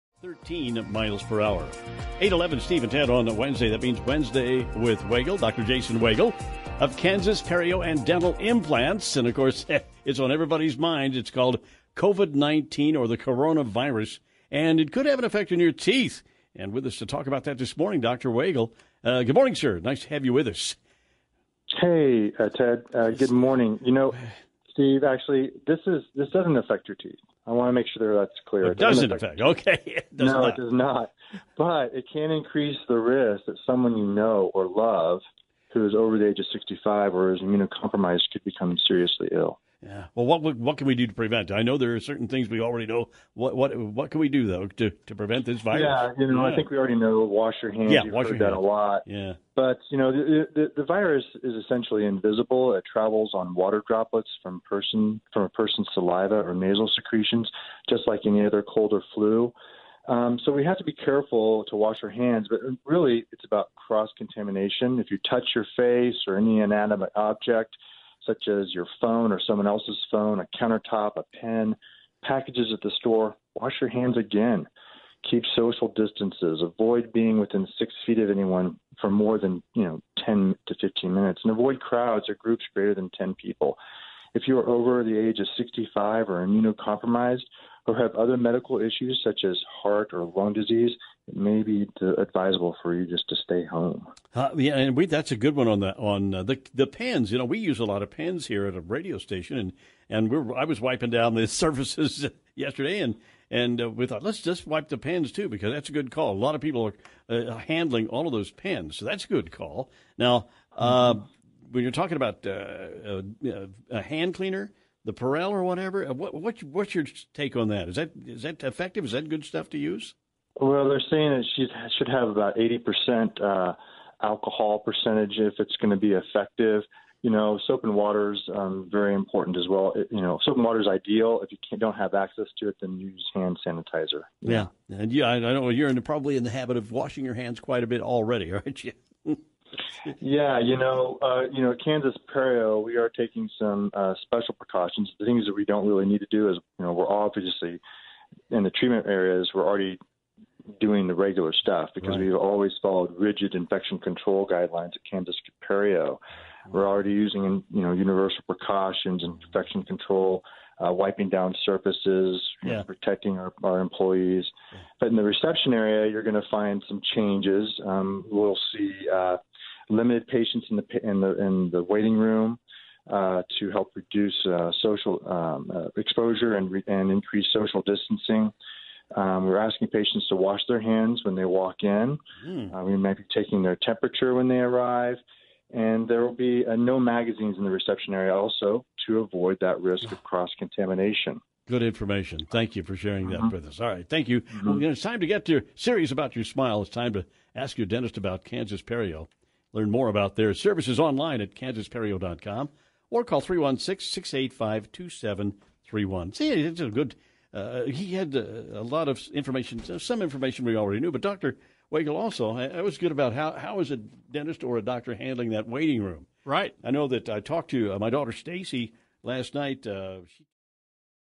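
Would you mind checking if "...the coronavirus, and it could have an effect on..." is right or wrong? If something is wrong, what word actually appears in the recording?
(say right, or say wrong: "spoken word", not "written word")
right.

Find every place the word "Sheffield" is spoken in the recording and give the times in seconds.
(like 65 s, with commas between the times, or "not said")
not said.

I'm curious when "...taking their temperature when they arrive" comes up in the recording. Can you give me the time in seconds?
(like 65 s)
183 s.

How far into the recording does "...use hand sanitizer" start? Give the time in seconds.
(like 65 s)
132 s.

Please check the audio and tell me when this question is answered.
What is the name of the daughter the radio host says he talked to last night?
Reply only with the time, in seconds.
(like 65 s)
218 s.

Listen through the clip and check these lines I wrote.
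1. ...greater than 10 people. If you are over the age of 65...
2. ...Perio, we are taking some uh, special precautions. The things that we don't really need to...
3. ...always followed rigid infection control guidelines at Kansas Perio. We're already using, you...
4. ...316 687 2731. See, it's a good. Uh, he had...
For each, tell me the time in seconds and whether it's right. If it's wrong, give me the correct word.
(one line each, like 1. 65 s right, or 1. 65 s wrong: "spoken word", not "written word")
1. 82 s right
2. 142 s right
3. 152 s right
4. 203 s wrong: "685", not "687".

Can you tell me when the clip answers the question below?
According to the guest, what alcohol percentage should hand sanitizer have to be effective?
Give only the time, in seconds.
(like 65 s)
122 s.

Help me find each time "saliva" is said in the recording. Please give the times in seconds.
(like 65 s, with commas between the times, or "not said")
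55 s.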